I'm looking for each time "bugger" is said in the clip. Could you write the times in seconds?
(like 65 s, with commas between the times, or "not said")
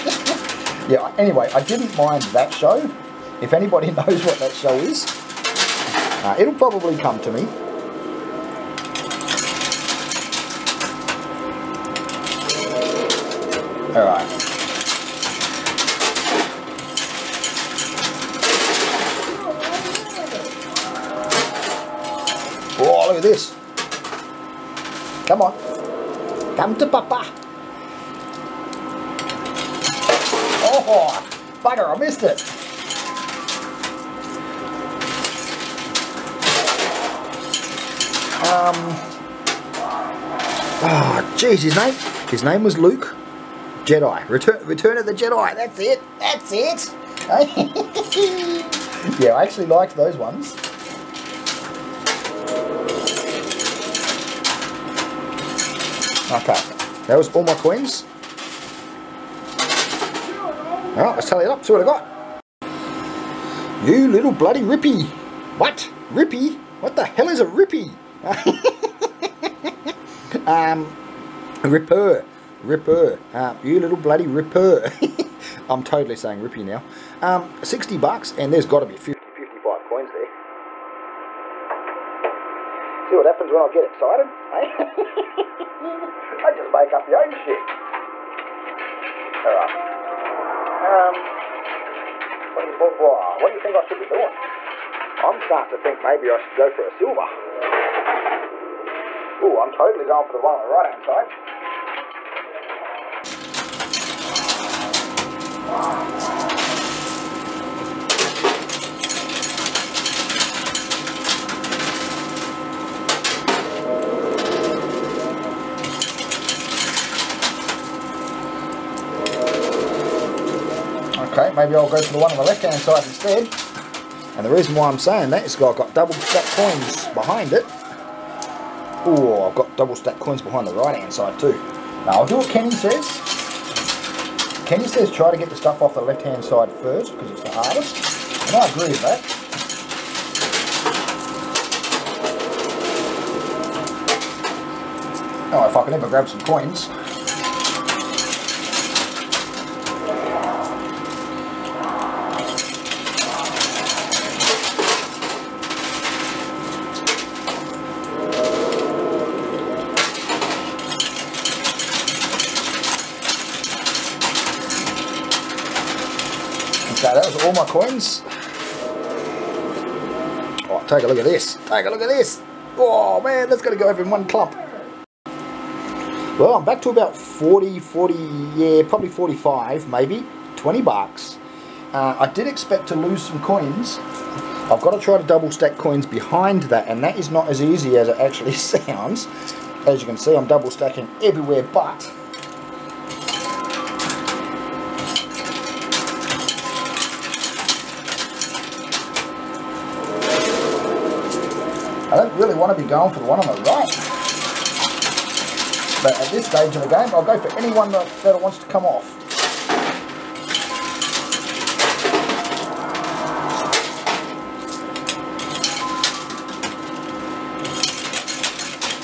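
31 s.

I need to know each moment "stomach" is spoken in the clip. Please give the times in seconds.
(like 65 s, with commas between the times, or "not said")
not said.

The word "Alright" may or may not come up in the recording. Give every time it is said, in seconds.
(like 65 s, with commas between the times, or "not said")
13 s, 60 s, 89 s.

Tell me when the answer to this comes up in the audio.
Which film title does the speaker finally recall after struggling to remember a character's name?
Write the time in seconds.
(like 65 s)
44 s.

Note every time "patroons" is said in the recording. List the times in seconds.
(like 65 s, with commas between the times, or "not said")
not said.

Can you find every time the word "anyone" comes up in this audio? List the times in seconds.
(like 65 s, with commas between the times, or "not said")
207 s.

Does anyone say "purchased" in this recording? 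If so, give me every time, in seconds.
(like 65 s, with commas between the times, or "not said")
not said.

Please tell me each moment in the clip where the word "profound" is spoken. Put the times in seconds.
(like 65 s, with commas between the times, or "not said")
not said.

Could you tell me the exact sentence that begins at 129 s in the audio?
Oh, I've got double stack coins behind the right-hand side too.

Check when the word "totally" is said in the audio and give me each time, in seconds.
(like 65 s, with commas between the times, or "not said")
75 s, 99 s.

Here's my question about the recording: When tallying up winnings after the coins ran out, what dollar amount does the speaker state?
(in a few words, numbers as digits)
$60.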